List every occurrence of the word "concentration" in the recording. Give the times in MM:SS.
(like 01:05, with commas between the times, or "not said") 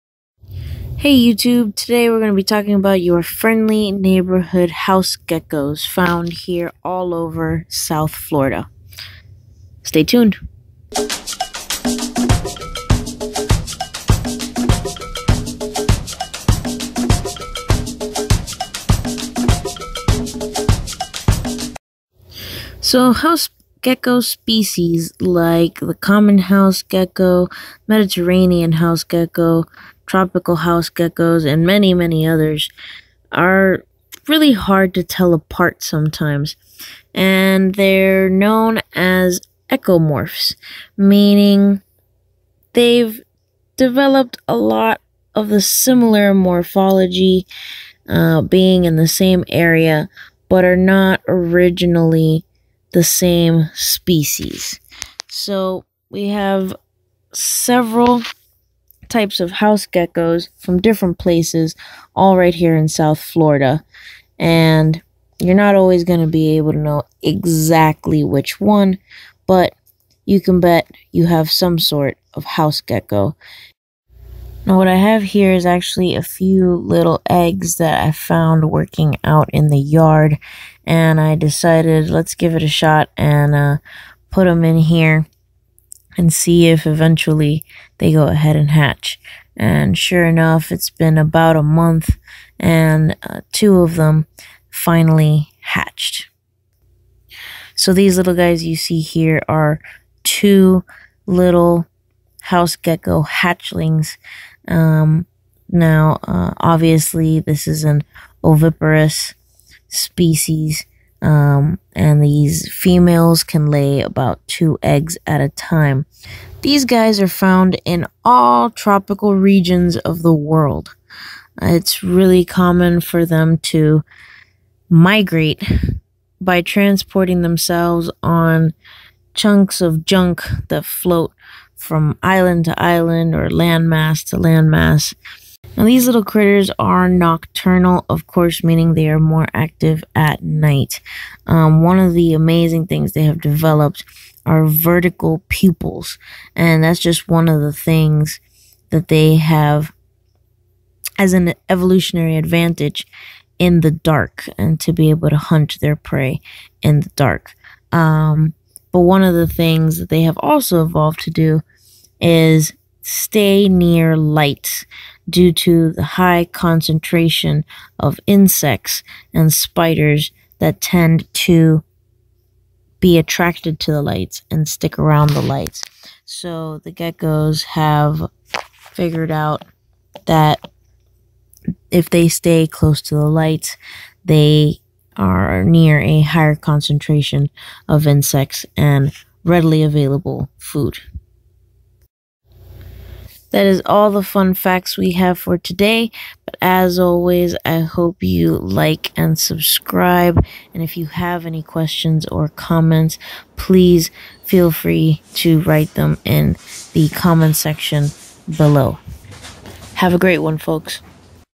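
02:46, 03:06.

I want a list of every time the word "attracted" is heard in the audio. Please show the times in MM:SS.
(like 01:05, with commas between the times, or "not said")
02:53.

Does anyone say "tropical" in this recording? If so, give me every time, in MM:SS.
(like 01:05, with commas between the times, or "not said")
00:30, 01:58.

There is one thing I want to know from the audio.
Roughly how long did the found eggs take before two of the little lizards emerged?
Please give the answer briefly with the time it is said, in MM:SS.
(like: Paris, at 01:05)
About a month, at 01:31.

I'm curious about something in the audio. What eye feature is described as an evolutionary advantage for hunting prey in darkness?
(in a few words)
Vertical pupils.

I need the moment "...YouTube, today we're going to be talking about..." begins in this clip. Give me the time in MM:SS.
00:01.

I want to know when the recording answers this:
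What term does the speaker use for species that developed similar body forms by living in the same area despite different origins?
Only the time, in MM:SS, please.
00:39.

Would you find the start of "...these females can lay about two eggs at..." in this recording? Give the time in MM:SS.
01:52.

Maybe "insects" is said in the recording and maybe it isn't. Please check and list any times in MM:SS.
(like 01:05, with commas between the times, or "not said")
02:48, 03:08.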